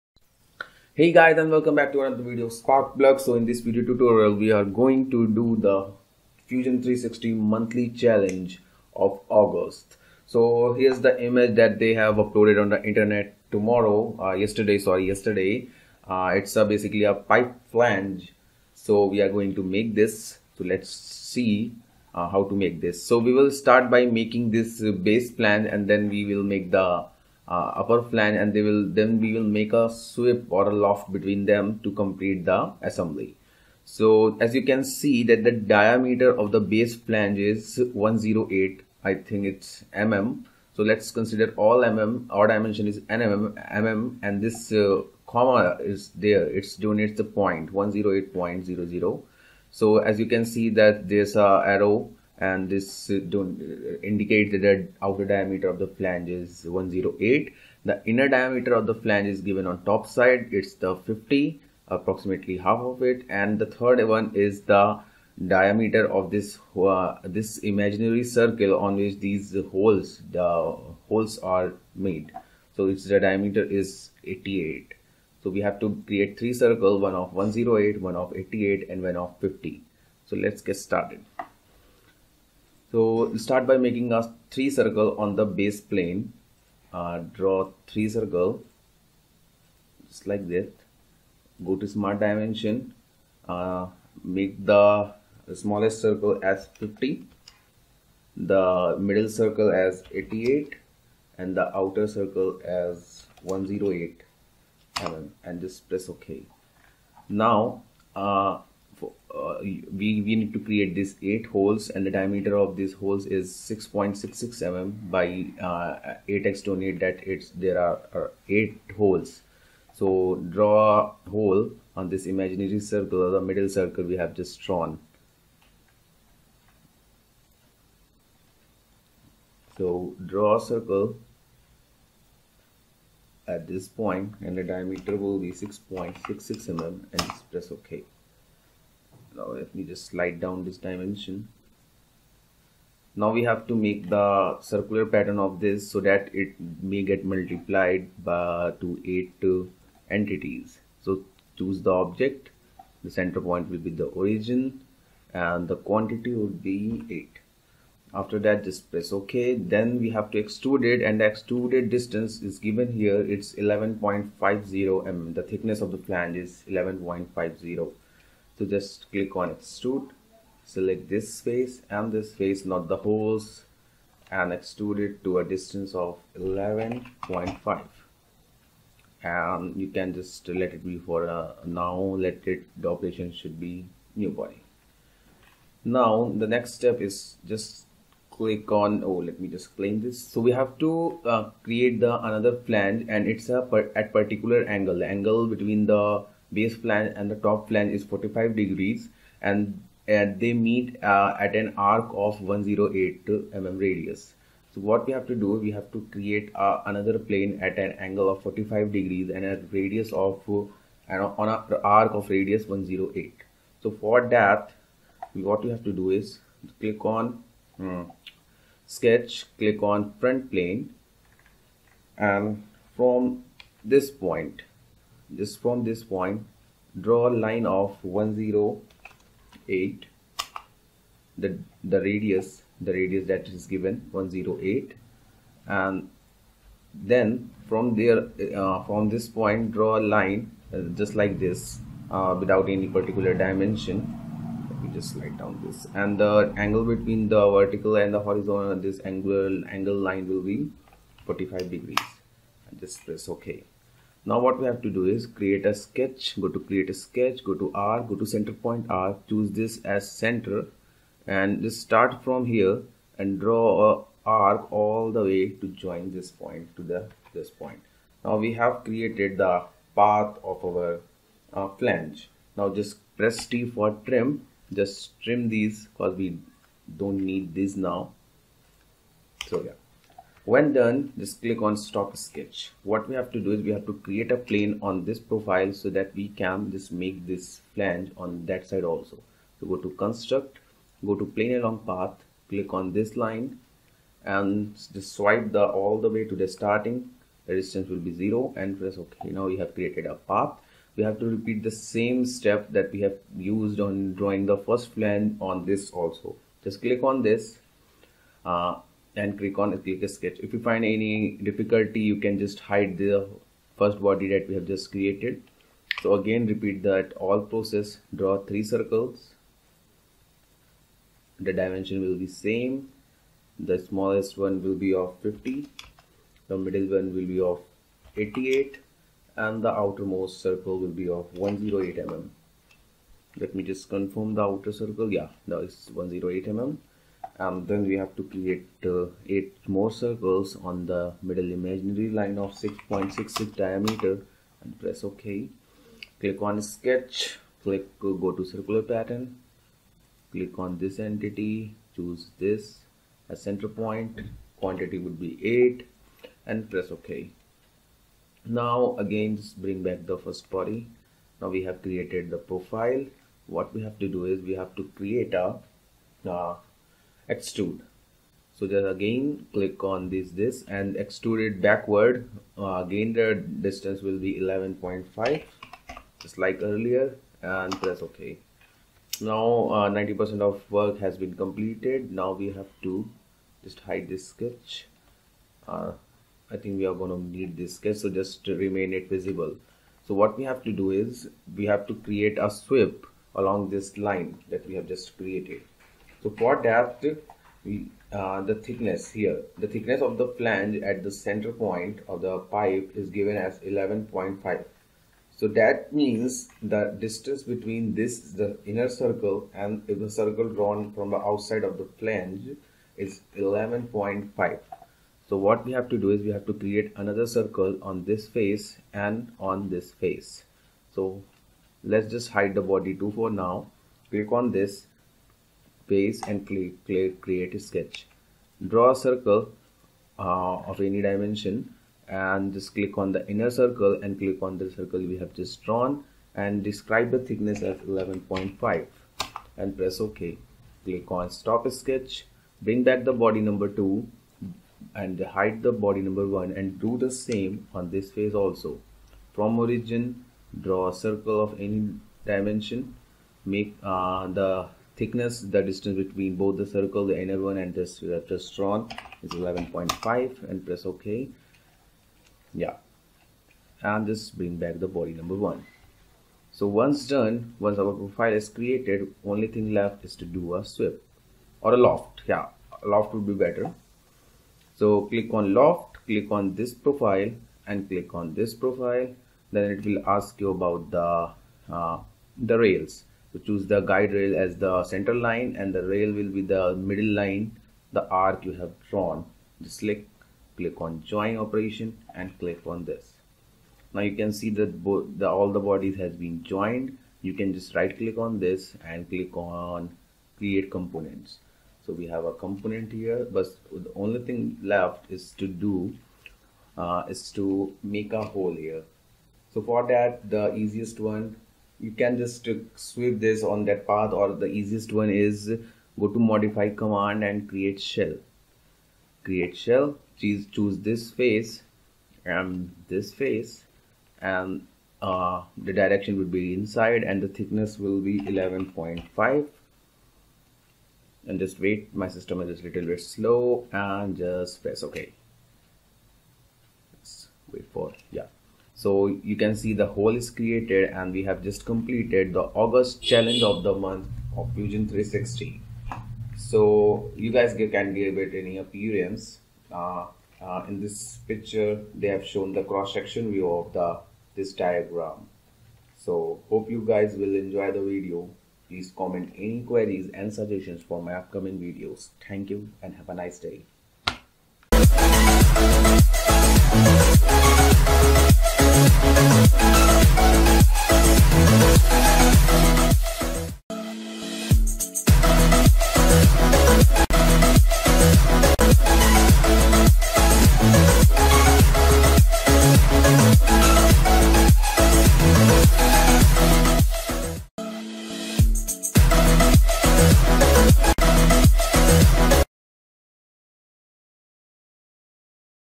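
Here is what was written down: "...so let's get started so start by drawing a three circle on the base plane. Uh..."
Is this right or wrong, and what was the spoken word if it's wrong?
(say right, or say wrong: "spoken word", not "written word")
wrong: "making", not "drawing".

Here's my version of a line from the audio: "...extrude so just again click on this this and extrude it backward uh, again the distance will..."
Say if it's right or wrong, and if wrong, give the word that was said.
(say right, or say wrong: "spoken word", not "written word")
right.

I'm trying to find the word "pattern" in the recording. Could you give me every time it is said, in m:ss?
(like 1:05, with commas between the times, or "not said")
2:25, 5:48.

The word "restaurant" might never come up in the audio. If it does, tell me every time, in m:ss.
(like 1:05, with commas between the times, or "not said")
7:38.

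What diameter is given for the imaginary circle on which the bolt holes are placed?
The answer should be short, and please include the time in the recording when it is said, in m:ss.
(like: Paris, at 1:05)
88, at 1:12.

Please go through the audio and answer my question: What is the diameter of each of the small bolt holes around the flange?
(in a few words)
6.66 mm.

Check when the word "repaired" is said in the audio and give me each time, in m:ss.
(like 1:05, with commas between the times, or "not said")
not said.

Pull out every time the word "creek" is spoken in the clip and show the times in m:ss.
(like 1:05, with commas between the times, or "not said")
not said.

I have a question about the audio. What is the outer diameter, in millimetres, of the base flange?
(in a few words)
108.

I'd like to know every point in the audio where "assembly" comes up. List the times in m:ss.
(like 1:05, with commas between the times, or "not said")
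0:32.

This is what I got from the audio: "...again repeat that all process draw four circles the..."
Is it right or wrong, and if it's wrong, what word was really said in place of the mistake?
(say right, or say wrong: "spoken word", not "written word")
wrong: "three", not "four".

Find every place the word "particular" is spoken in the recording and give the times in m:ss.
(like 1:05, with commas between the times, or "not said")
3:14, 4:02.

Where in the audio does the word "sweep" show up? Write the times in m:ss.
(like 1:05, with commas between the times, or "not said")
0:29, 6:32, 7:50, 8:32.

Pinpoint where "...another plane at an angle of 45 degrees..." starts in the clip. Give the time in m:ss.
3:26.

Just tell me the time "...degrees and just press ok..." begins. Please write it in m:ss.
4:11.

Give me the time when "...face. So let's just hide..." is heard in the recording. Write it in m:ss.
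6:59.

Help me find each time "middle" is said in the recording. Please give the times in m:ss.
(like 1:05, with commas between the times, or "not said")
1:38, 2:03, 5:26, 5:41, 8:06.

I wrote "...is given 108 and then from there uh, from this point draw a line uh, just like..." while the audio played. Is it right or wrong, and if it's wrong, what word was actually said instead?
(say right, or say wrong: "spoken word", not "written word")
right.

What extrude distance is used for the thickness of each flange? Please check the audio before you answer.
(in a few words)
11.50 mm.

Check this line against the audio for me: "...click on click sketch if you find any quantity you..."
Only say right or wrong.
wrong.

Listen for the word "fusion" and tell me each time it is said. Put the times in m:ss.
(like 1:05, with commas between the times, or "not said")
0:06, 9:04.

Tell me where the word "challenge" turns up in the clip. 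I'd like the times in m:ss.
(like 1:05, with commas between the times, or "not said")
0:07, 9:03.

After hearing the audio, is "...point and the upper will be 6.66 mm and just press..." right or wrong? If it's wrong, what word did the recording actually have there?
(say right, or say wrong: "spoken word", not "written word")
wrong: "diameter", not "upper".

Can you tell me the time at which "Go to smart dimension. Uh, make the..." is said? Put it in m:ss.
1:31.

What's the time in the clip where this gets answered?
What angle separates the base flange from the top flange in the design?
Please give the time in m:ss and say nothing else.
3:18.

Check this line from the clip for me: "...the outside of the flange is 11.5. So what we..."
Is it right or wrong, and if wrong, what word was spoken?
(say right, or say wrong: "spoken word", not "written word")
right.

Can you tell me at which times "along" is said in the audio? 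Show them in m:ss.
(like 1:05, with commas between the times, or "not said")
4:51, 6:33.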